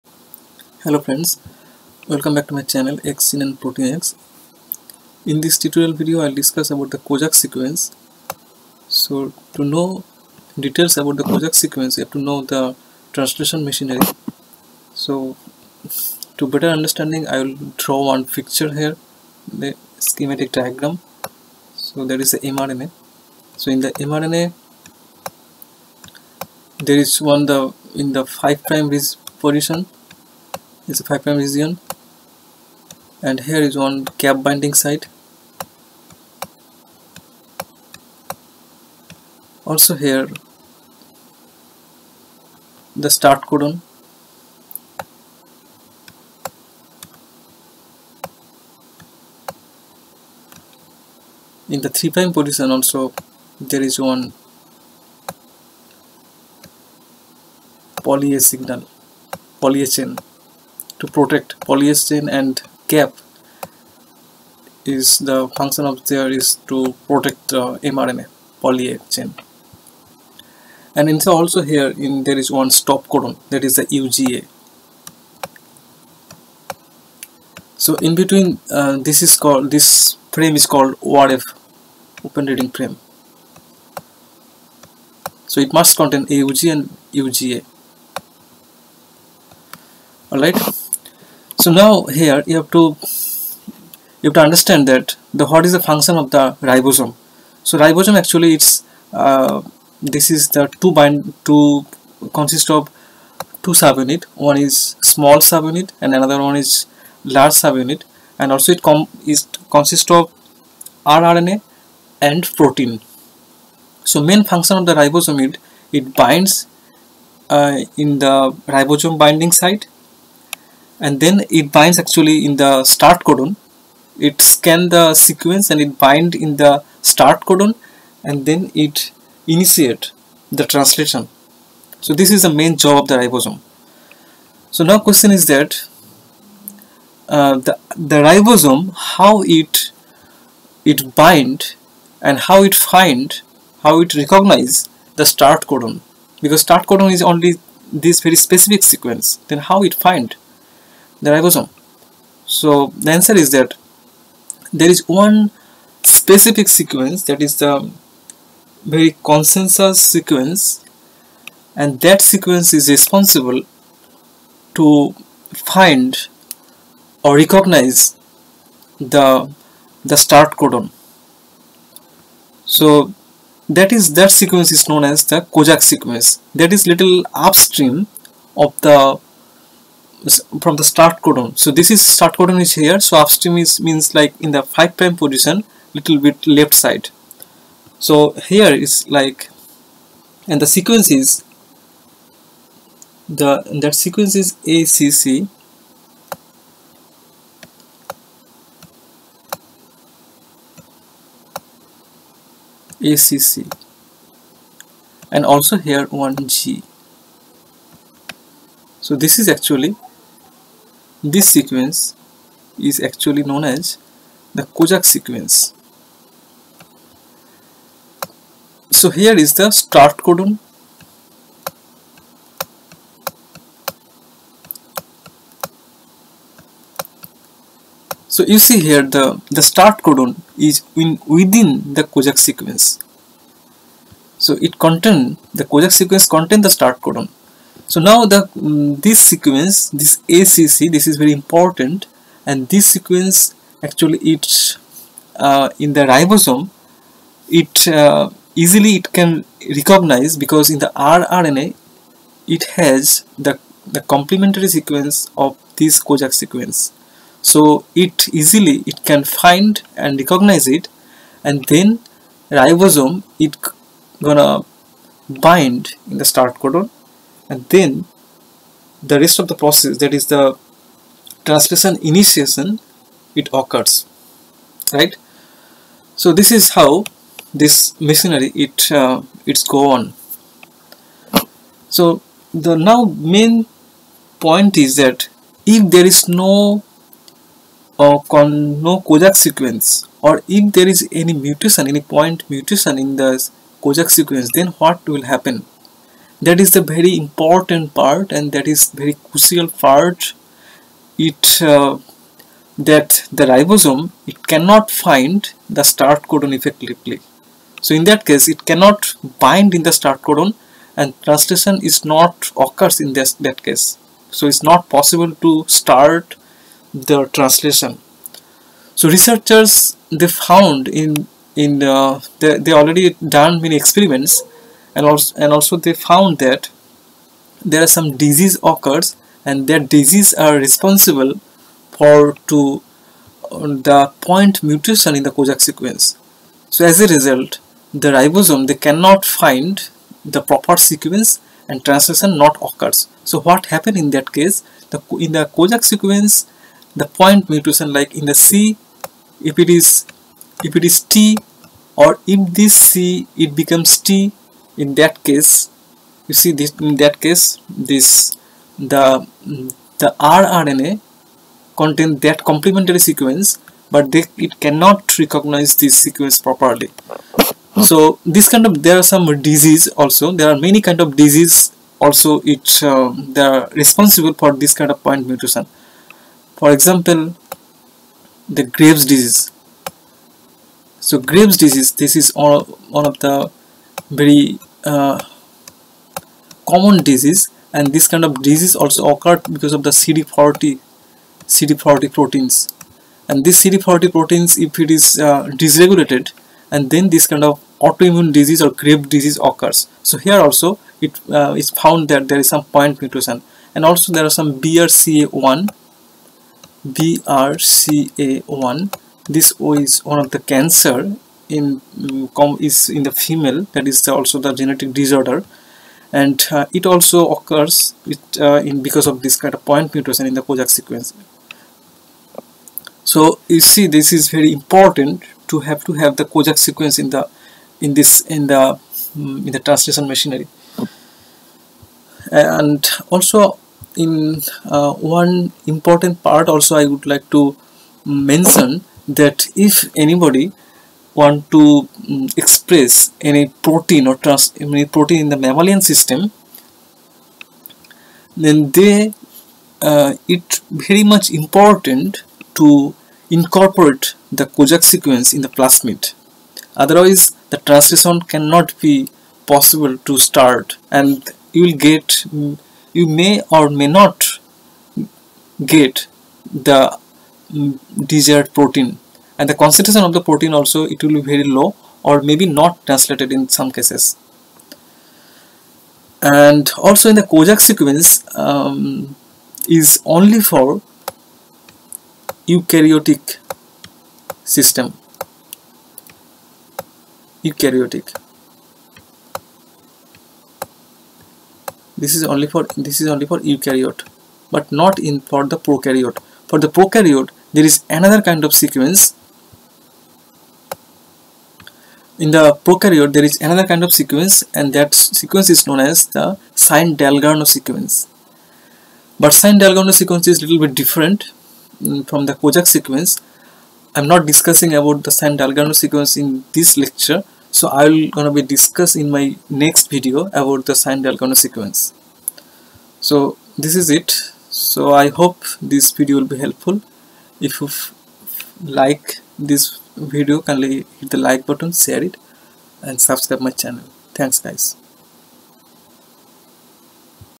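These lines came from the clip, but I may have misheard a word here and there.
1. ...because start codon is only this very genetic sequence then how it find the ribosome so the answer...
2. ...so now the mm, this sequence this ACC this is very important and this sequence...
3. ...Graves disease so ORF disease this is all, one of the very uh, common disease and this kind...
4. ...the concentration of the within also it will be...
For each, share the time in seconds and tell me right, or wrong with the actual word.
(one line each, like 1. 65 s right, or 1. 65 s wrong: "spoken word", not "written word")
1. 146 s wrong: "specific", not "genetic"
2. 237 s right
3. 378 s wrong: "Graves", not "ORF"
4. 469 s wrong: "protein", not "within".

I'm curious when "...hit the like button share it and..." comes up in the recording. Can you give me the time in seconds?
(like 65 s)
530 s.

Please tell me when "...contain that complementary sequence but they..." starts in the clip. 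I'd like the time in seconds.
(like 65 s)
361 s.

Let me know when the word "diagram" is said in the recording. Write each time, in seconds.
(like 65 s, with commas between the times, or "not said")
20 s.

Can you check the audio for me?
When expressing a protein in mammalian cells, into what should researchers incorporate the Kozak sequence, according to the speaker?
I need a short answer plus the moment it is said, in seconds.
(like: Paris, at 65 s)
the plasmid, at 455 s.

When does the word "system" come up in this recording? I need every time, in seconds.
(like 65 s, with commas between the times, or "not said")
445 s, 484 s.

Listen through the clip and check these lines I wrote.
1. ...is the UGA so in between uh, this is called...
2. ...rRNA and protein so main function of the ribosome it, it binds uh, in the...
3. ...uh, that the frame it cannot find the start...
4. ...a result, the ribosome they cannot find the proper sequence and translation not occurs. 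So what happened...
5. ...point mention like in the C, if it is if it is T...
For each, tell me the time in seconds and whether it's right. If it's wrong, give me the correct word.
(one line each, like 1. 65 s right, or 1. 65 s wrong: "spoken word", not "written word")
1. 73 s right
2. 111 s right
3. 301 s wrong: "ribosome", not "frame"
4. 337 s right
5. 347 s wrong: "mutation", not "mention".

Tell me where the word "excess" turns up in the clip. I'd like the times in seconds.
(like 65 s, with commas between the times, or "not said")
not said.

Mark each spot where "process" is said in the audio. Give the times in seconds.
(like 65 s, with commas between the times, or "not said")
269 s.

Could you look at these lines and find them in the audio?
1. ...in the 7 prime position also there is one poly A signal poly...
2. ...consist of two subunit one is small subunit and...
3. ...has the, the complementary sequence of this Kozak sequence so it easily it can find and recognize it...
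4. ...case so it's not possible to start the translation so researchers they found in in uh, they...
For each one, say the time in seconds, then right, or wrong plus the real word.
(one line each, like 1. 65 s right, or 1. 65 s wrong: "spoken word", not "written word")
1. 51 s wrong: "3", not "7"
2. 102 s right
3. 252 s right
4. 313 s right.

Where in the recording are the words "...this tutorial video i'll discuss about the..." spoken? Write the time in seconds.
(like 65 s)
5 s.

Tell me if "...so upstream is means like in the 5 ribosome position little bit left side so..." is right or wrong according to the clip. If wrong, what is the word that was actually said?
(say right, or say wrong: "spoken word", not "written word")
wrong: "prime", not "ribosome".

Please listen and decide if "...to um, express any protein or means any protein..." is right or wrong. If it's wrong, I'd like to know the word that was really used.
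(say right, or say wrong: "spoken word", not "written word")
wrong: "trans", not "means".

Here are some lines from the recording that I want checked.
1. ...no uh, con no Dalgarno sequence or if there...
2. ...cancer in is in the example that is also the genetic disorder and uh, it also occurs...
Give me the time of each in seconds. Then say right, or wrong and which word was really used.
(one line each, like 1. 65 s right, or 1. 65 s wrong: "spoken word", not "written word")
1. 286 s wrong: "Kozak", not "Dalgarno"
2. 410 s wrong: "female", not "example".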